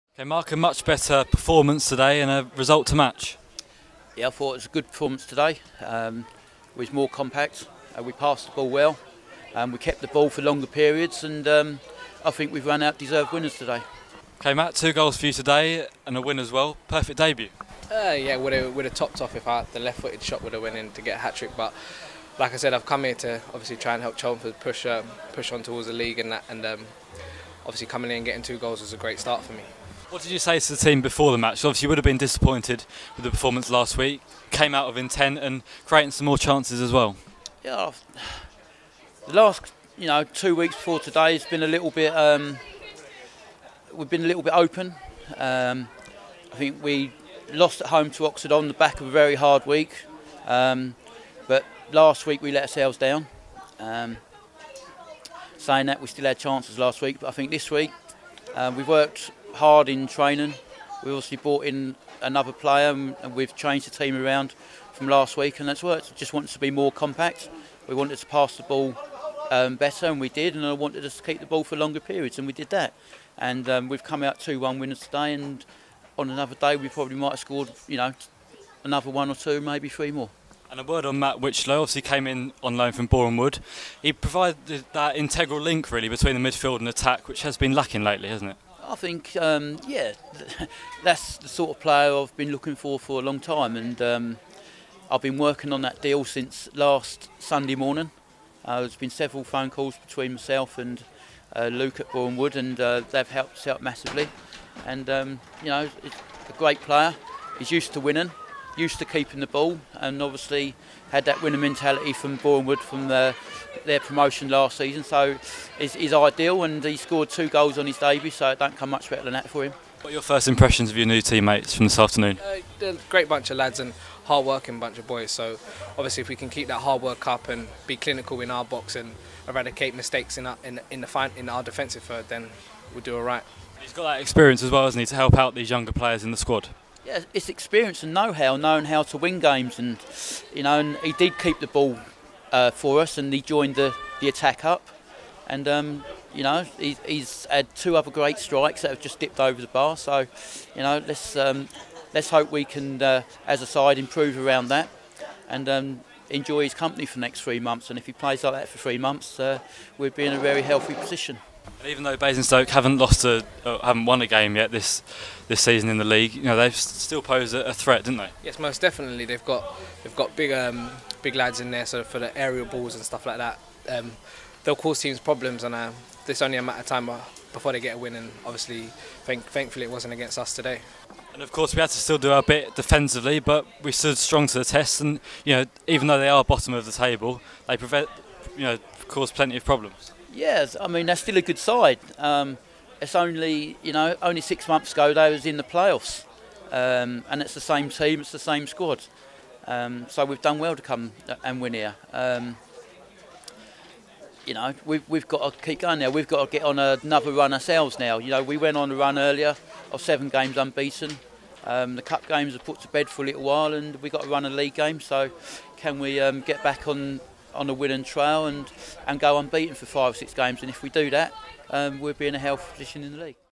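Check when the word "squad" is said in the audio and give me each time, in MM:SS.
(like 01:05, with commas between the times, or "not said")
02:16, 03:18.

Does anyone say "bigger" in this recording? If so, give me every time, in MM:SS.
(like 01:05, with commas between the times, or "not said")
not said.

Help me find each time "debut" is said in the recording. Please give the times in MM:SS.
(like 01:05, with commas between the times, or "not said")
00:17, 01:57.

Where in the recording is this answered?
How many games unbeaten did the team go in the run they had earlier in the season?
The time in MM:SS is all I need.
03:30.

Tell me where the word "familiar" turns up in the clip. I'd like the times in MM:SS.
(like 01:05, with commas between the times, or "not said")
not said.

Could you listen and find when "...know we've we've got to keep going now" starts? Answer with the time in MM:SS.
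03:24.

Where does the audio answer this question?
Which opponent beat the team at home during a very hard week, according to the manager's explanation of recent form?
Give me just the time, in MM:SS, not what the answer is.
00:48.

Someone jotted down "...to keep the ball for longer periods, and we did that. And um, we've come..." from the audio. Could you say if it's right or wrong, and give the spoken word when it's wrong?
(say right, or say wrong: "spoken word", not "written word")
right.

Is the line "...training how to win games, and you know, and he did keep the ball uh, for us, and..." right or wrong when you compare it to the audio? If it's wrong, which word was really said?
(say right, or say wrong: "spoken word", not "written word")
wrong: "knowing", not "training".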